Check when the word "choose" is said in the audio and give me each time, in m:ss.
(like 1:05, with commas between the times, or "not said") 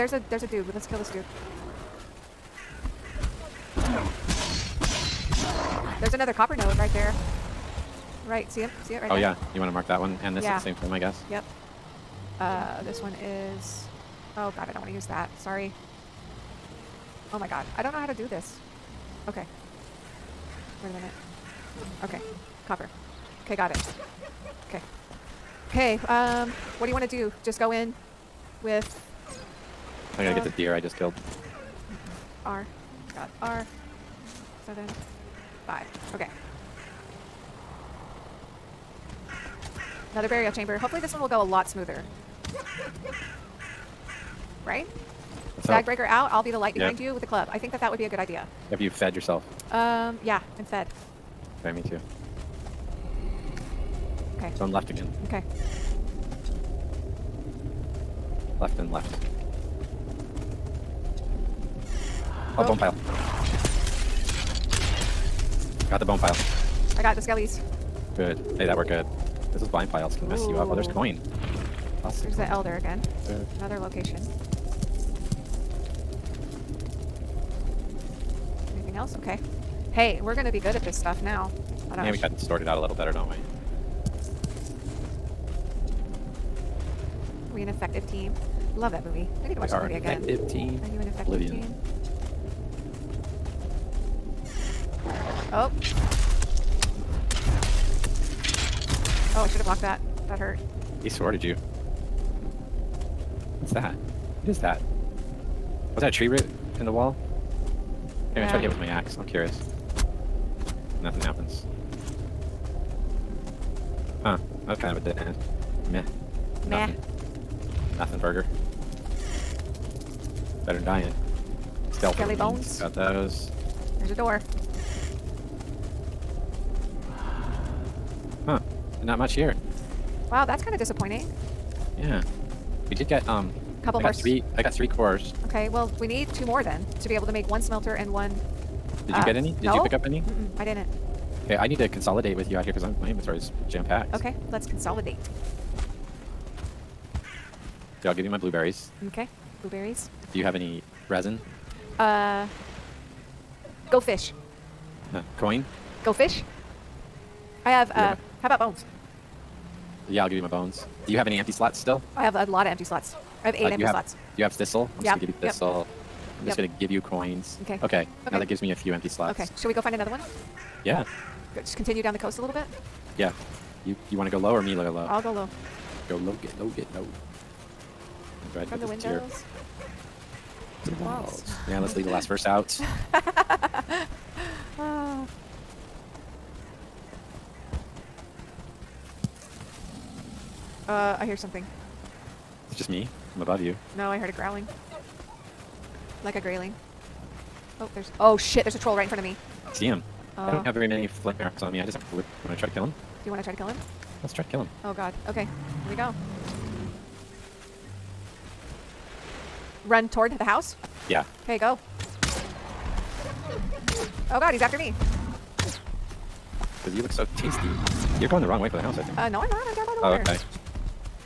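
not said.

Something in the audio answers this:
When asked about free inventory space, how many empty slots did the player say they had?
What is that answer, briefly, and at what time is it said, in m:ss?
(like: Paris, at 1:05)
8, at 2:43.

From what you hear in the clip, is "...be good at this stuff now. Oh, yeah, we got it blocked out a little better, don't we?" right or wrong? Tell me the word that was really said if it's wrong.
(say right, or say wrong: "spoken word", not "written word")
wrong: "sorted", not "blocked".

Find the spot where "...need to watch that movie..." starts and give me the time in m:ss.
1:29.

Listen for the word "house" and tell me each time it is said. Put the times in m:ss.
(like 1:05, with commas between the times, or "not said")
3:30, 3:38.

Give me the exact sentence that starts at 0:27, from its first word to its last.
Just go in with I'm gonna get this deer I just killed.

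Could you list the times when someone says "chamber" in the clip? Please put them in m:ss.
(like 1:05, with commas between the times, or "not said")
0:40.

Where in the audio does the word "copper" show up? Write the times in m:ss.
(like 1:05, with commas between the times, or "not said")
0:06, 0:22.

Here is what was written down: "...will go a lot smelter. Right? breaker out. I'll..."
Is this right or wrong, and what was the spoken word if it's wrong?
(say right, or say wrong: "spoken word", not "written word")
wrong: "smoother", not "smelter".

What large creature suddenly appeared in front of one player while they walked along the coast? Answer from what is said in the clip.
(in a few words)
A troll.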